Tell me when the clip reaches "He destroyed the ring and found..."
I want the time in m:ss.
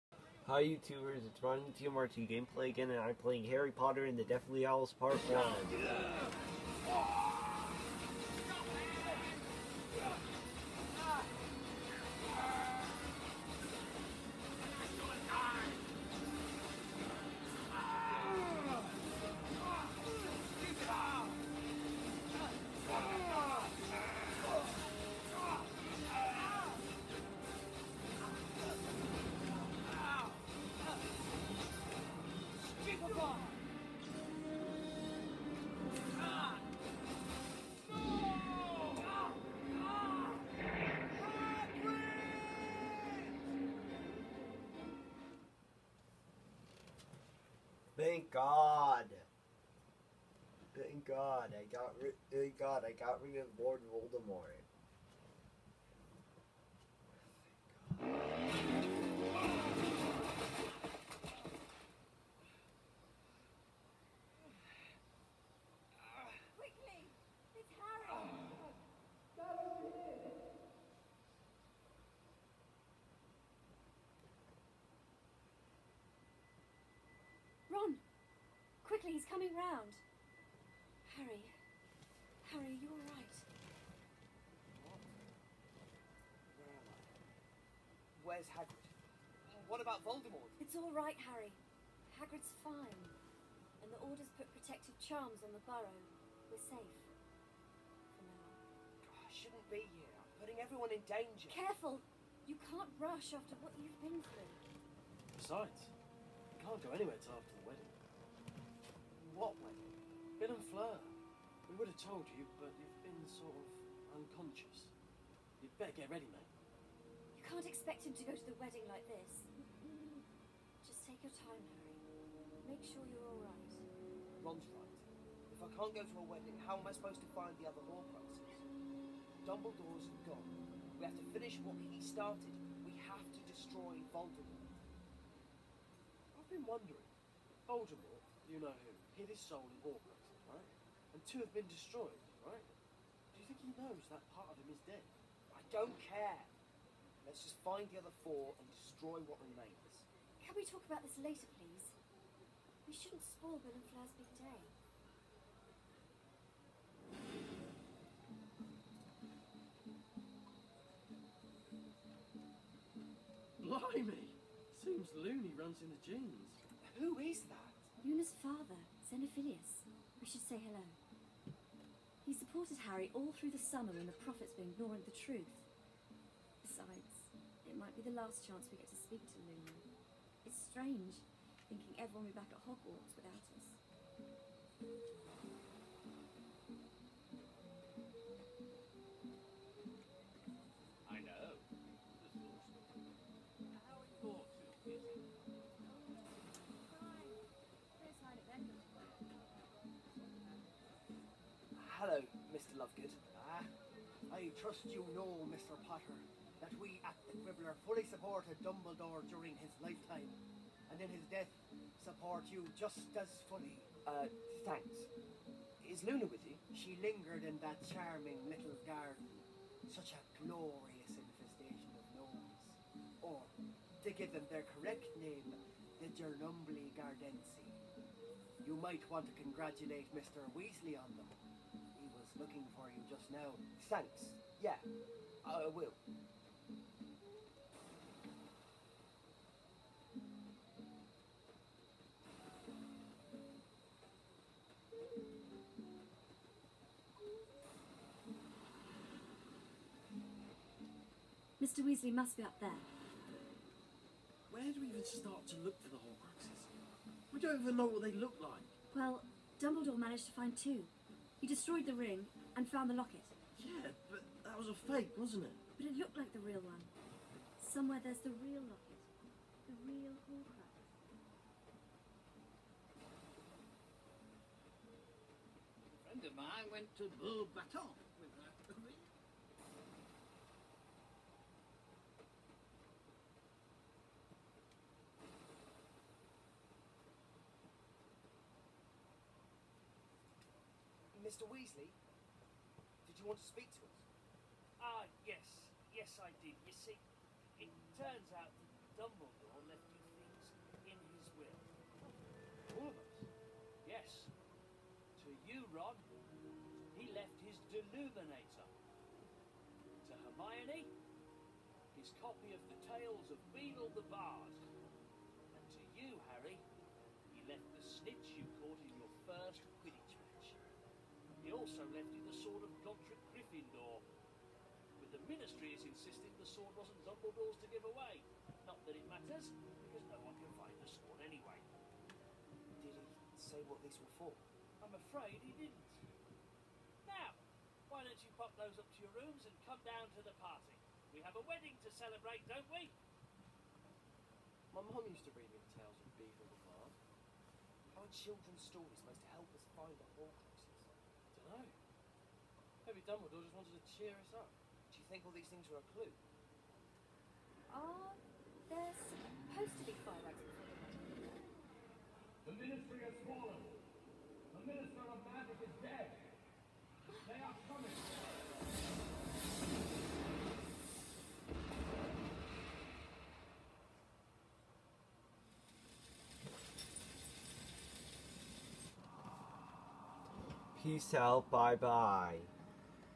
4:21.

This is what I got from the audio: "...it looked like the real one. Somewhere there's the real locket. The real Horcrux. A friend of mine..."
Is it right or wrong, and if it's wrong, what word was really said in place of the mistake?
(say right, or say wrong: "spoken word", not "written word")
right.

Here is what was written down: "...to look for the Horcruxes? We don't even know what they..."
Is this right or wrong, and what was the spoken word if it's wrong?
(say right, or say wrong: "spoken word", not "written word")
right.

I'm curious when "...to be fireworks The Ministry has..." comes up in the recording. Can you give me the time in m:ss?
5:59.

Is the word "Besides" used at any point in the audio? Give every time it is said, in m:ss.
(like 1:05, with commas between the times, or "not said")
1:45, 2:56.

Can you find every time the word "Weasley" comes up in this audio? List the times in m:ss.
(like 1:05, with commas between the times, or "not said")
3:50, 4:11, 4:51.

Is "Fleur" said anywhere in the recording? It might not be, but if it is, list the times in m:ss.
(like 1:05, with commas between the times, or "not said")
1:50, 2:33.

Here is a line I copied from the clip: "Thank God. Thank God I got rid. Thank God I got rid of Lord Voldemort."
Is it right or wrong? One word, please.
right.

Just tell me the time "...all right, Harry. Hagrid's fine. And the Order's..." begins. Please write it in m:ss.
1:30.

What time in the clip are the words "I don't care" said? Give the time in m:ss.
2:25.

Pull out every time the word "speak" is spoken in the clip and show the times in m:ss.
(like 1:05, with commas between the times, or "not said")
2:58, 4:53.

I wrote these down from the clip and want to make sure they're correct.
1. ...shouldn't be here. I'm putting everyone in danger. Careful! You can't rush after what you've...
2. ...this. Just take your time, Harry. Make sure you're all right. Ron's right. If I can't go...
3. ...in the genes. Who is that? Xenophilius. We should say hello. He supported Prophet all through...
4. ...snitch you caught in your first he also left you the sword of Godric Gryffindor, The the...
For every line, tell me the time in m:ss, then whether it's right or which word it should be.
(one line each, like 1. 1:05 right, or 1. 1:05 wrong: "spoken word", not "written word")
1. 1:39 right
2. 1:59 right
3. 2:45 wrong: "Harry", not "Prophet"
4. 5:18 wrong: "But", not "The".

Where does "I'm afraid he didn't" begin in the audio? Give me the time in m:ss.
5:34.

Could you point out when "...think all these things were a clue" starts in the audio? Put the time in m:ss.
5:55.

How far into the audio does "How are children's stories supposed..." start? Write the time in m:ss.
5:47.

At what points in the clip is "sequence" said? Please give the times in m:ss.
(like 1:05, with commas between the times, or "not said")
not said.